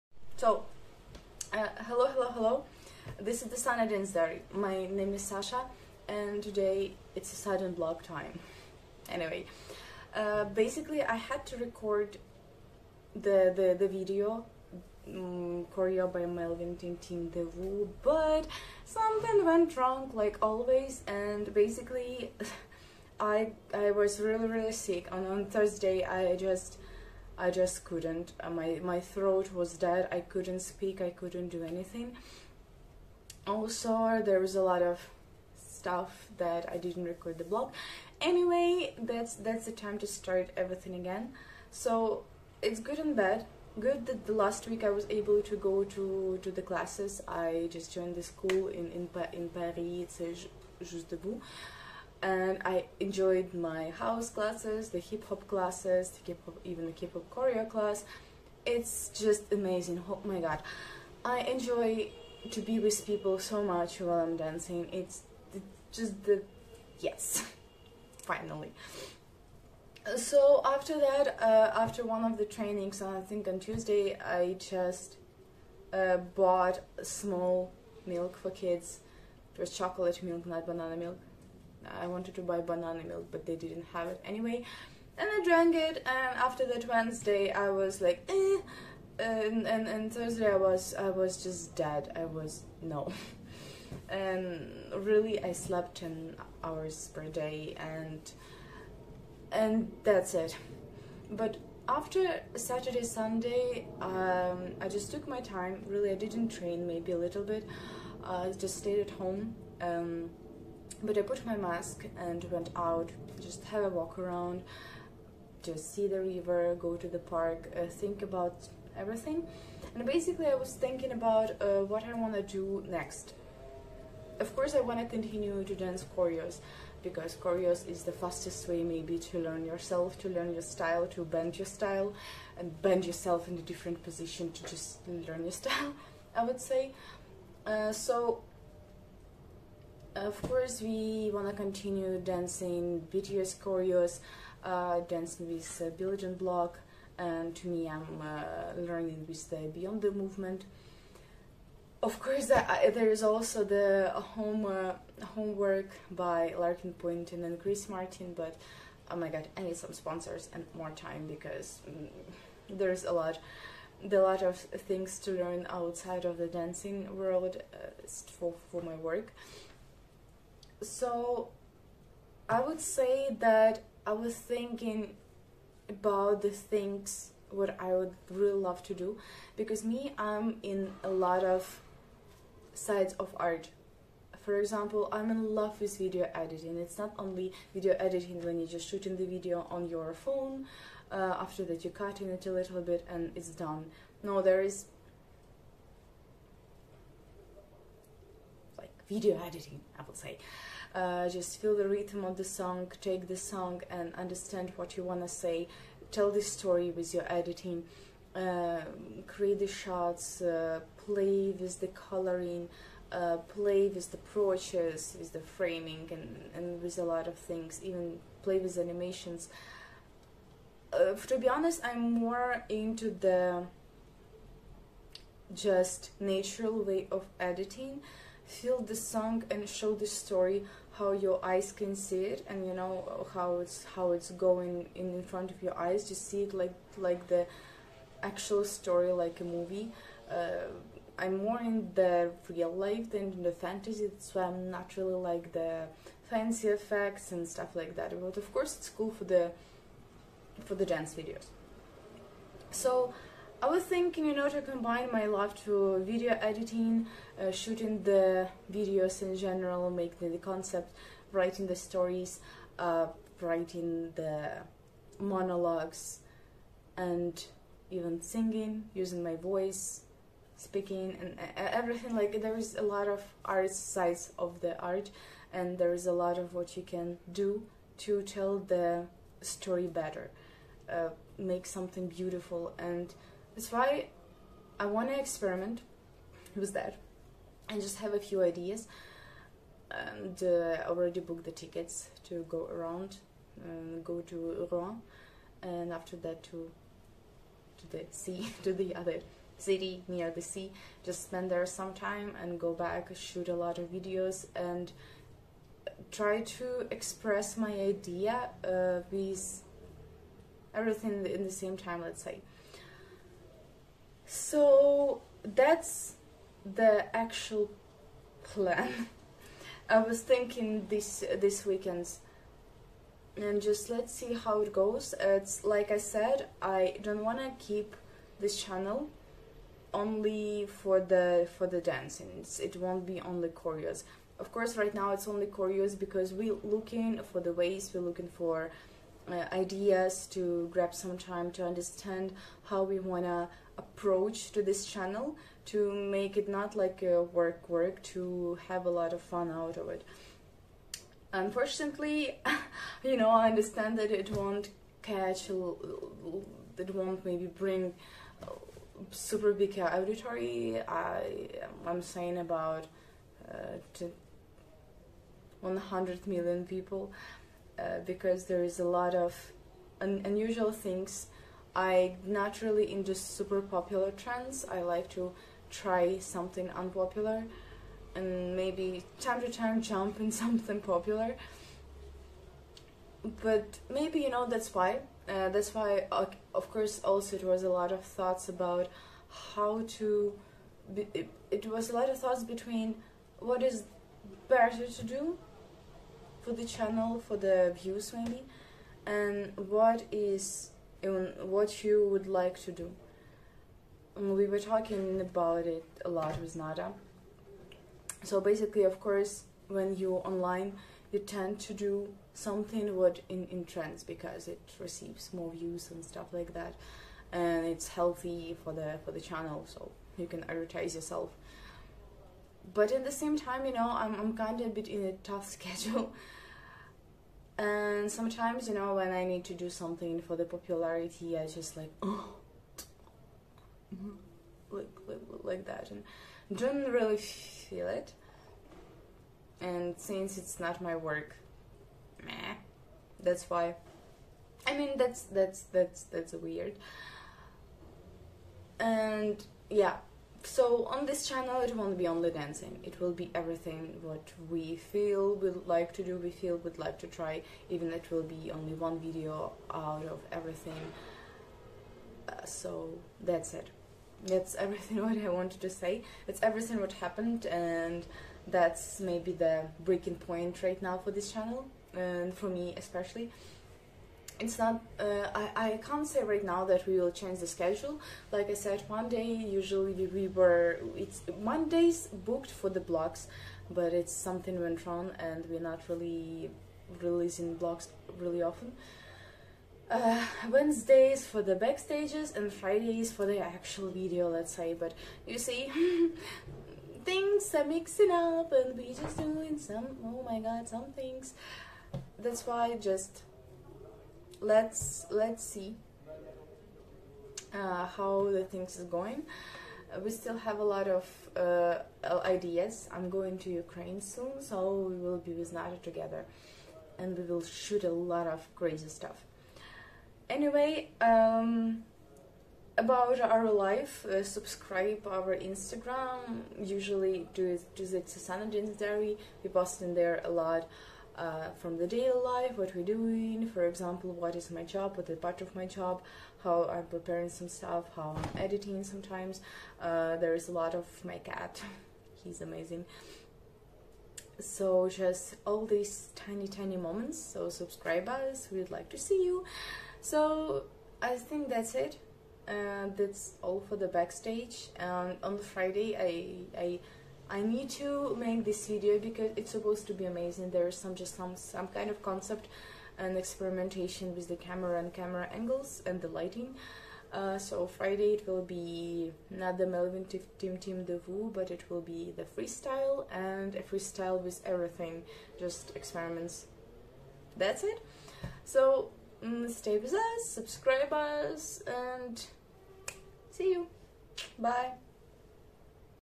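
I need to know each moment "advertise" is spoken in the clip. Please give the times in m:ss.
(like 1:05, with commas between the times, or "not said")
7:00.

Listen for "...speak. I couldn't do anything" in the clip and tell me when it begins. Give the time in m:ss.
0:30.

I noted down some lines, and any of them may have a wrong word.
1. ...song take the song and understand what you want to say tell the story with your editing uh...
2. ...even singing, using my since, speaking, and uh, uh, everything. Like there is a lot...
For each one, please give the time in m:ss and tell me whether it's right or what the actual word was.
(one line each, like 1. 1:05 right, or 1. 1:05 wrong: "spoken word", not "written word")
1. 3:22 right
2. 4:27 wrong: "voice", not "since".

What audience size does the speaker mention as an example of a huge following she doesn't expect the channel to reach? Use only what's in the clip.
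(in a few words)
100 million.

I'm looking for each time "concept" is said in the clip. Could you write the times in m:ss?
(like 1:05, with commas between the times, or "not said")
4:20, 9:22.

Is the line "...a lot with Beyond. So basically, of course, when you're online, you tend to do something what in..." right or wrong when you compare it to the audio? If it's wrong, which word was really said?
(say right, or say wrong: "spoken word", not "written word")
wrong: "Nada", not "Beyond".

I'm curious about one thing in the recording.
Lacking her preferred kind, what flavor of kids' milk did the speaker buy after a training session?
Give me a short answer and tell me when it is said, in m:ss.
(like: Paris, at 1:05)
Chocolate, at 1:19.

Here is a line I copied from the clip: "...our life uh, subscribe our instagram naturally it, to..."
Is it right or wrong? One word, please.
wrong.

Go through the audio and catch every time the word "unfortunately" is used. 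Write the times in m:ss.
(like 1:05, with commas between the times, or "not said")
5:51.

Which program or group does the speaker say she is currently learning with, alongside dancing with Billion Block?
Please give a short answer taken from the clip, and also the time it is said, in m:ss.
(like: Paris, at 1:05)
Beyond the Movement, at 2:29.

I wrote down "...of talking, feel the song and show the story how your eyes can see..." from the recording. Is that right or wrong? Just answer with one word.
wrong.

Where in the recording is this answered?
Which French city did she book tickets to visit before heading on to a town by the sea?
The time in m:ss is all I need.
4:54.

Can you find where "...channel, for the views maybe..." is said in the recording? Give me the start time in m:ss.
6:36.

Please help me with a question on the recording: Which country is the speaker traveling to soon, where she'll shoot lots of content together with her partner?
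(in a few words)
Ukraine.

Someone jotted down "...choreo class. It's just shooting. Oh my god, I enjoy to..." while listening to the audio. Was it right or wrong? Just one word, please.
wrong.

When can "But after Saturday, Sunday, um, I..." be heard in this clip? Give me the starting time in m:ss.
1:41.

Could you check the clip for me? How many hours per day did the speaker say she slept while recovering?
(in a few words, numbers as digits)
10.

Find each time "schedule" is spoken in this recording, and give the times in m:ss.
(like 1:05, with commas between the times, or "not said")
7:05, 7:57.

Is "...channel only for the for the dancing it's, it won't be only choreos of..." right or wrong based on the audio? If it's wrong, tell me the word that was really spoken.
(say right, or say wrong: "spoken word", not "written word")
right.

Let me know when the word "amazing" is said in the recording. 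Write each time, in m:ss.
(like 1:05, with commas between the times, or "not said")
0:59, 9:02, 9:20.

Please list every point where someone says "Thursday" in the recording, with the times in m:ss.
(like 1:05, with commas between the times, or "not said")
0:25, 1:30.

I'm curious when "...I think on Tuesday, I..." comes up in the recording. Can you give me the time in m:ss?
1:13.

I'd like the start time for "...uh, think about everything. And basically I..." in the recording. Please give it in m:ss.
1:57.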